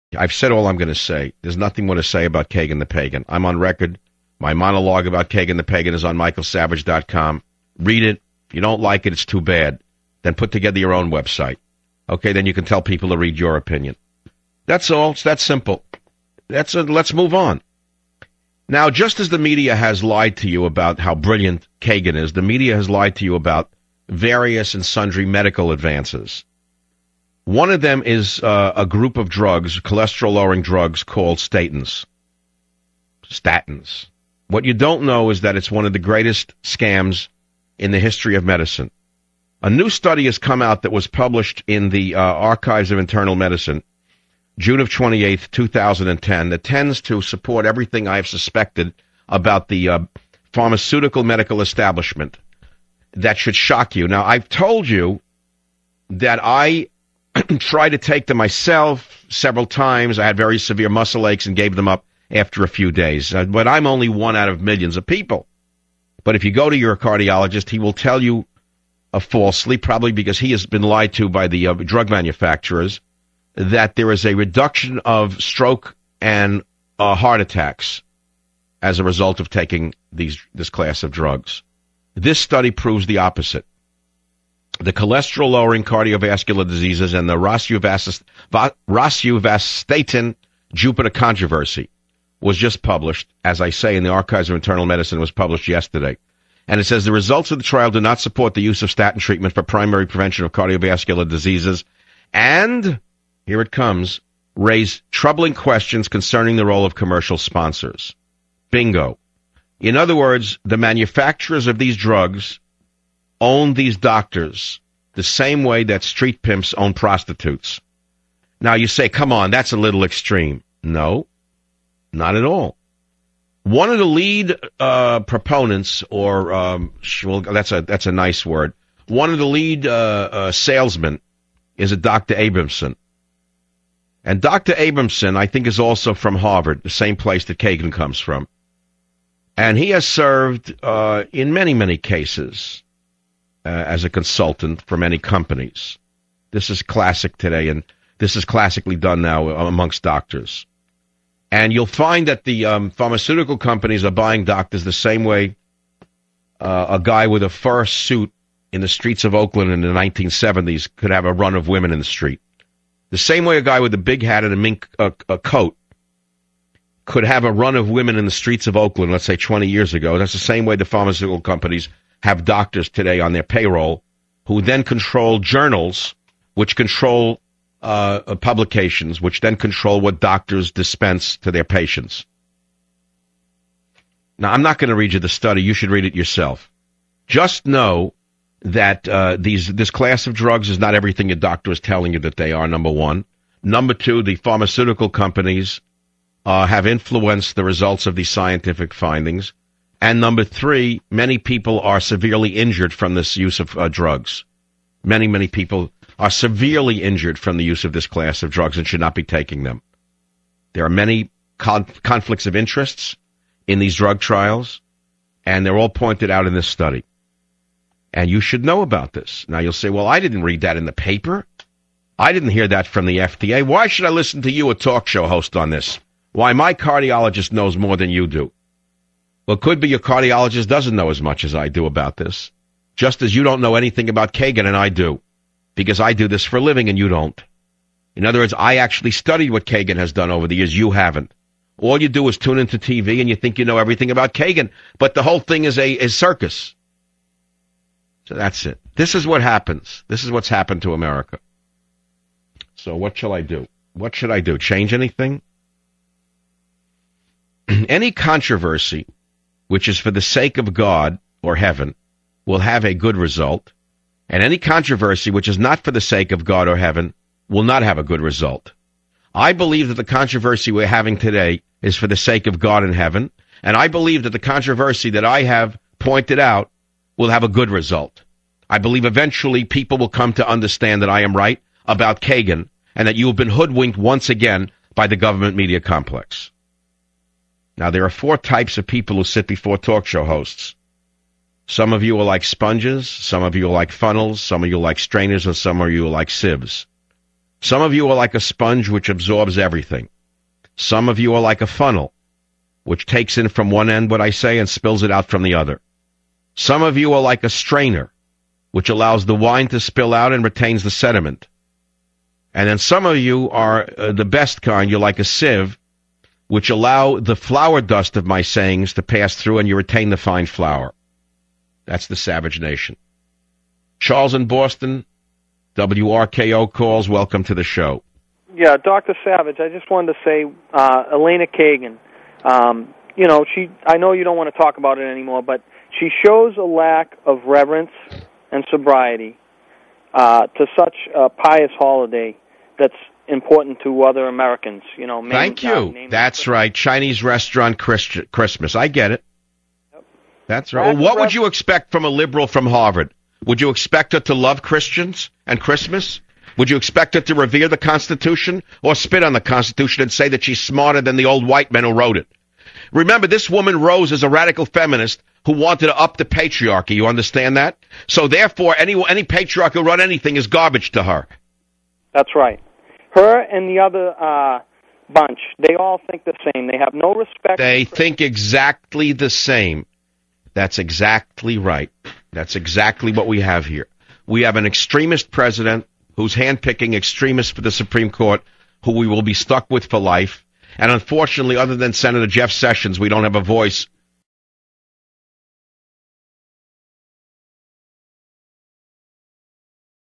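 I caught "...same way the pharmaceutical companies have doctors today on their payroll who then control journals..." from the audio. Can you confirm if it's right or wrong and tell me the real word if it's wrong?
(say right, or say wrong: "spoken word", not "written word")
right.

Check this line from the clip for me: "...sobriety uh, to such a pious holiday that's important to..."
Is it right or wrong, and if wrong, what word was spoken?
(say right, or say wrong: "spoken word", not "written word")
right.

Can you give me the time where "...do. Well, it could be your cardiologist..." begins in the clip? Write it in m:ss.
3:48.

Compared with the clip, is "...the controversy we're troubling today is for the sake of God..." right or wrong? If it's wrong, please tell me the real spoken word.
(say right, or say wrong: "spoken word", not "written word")
wrong: "having", not "troubling".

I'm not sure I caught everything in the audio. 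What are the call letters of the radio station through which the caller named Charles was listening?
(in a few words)
WRKO.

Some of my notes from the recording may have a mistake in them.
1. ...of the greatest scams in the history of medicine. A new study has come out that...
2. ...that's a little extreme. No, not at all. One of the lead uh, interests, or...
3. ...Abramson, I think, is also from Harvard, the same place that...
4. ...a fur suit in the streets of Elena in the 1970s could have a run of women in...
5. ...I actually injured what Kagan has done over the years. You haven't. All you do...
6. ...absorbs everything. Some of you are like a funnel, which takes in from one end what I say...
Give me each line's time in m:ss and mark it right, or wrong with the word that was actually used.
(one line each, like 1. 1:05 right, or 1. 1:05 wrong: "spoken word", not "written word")
1. 0:35 right
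2. 1:59 wrong: "proponents", not "interests"
3. 2:14 right
4. 2:37 wrong: "Oakland", not "Elena"
5. 3:58 wrong: "studied", not "injured"
6. 4:59 right.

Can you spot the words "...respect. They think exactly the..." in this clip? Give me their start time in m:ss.
6:17.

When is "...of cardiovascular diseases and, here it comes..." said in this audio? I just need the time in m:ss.
1:40.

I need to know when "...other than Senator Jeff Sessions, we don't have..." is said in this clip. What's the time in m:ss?
6:31.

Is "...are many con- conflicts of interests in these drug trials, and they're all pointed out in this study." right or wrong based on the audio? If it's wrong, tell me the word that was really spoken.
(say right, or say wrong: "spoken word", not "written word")
right.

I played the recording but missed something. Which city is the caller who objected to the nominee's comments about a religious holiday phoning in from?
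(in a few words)
Boston.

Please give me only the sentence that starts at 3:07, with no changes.
Just know that uh, these this class of drugs is not everything your doctor is telling you that they are.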